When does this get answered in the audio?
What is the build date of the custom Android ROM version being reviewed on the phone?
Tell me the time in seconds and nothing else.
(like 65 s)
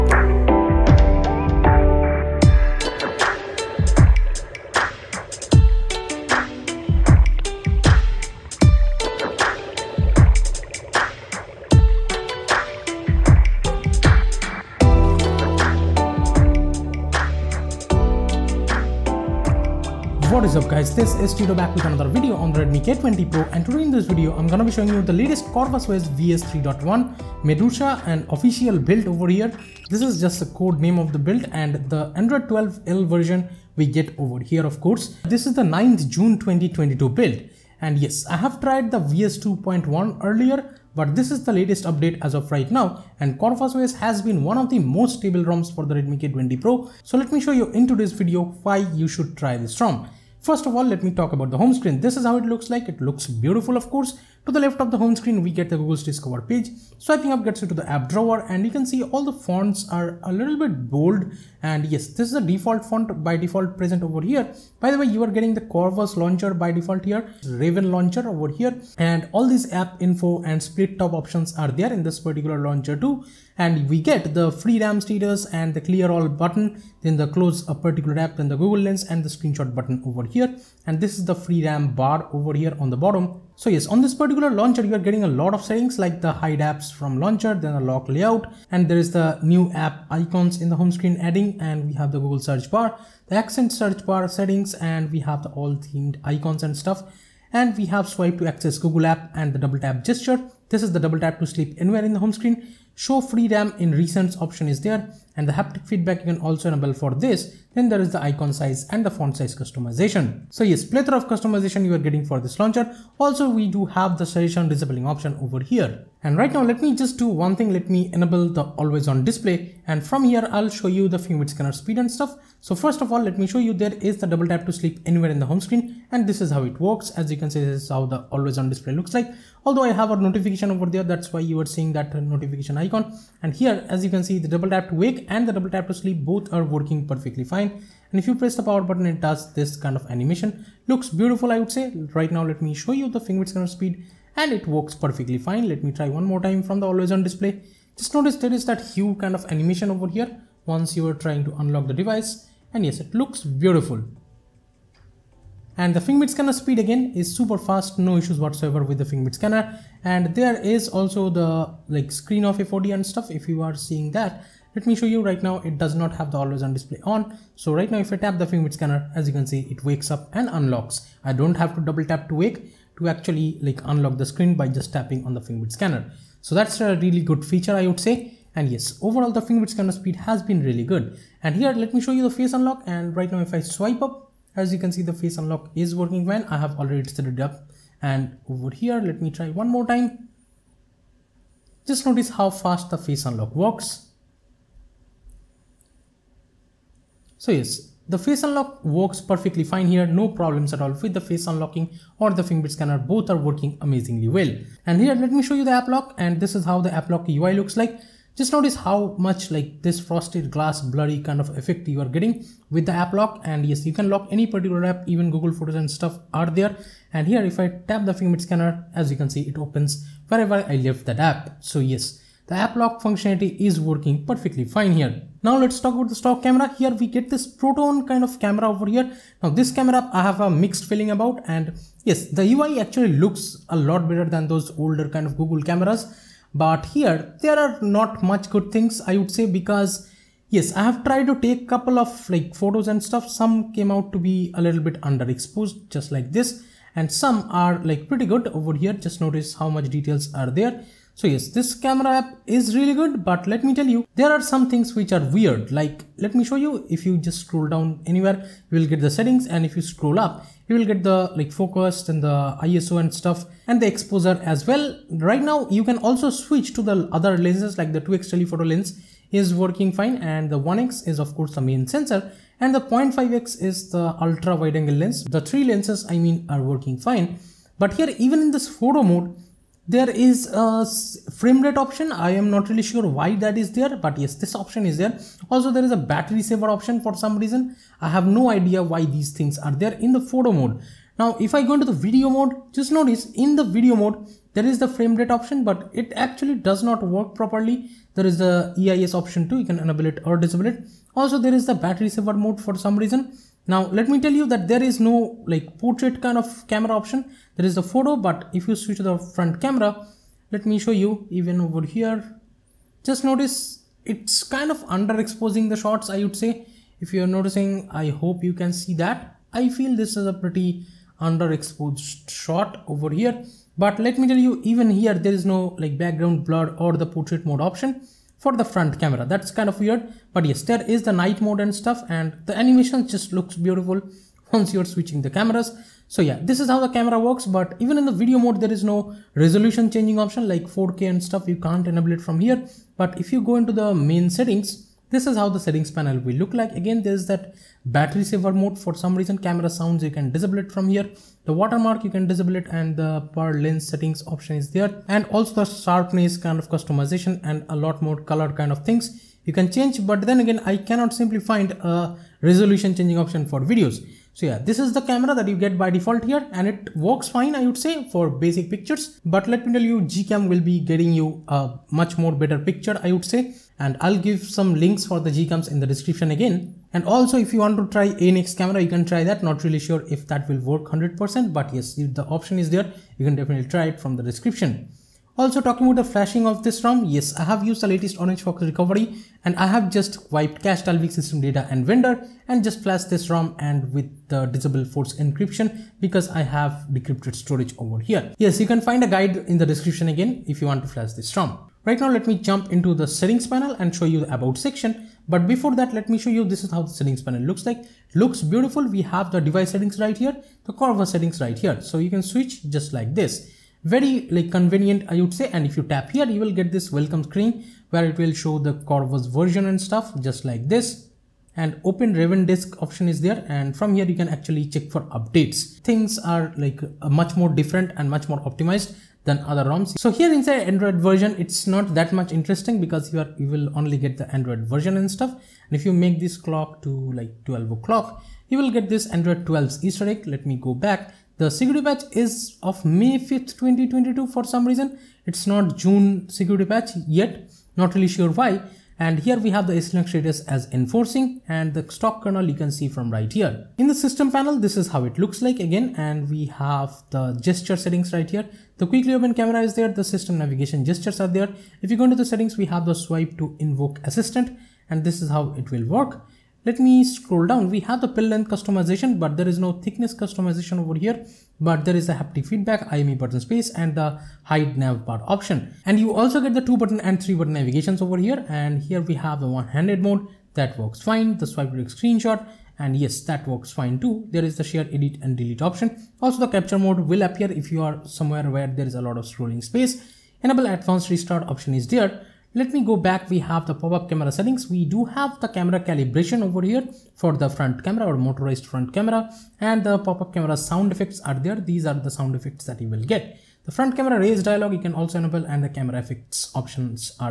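35 s.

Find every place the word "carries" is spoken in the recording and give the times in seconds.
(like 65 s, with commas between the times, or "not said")
not said.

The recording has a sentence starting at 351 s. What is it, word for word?
The watermark, you can disable it and the per lens settings option is there.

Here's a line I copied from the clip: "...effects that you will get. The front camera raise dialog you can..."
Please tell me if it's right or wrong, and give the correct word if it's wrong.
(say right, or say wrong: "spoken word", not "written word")
right.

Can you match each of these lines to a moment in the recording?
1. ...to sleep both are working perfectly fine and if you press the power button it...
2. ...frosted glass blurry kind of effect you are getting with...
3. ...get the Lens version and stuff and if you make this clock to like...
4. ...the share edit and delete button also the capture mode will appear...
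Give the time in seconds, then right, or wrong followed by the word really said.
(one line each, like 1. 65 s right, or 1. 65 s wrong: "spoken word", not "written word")
1. 135 s right
2. 209 s right
3. 433 s wrong: "Android", not "Lens"
4. 484 s wrong: "option", not "button".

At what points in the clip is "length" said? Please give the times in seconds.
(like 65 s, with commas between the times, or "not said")
468 s.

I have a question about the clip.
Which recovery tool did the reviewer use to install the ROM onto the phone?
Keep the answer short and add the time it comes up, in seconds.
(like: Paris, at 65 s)
Orange Fox, at 388 s.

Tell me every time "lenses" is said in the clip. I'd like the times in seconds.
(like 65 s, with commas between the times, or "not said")
267 s, 275 s.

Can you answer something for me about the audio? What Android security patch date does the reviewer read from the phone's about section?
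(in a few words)
May 5th, 2022.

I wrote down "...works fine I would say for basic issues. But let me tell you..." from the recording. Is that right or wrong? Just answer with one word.
wrong.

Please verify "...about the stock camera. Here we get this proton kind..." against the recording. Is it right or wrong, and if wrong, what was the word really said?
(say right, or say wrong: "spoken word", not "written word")
right.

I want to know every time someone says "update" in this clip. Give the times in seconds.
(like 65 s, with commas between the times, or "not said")
41 s, 425 s.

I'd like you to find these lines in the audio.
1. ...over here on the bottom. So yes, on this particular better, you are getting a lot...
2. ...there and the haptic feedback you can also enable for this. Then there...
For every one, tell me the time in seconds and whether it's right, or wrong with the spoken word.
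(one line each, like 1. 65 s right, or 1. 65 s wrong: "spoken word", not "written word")
1. 82 s wrong: "launcher", not "better"
2. 104 s right.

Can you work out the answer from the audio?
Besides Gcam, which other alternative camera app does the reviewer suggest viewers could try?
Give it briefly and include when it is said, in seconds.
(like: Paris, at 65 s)
ANX camera, at 378 s.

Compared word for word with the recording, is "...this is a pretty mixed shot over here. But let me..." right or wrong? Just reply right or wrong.
wrong.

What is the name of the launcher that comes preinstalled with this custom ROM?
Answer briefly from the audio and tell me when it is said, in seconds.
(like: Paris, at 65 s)
Raven launcher, at 67 s.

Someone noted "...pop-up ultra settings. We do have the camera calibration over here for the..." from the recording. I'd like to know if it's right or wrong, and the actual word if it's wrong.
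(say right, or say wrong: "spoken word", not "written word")
wrong: "camera", not "ultra".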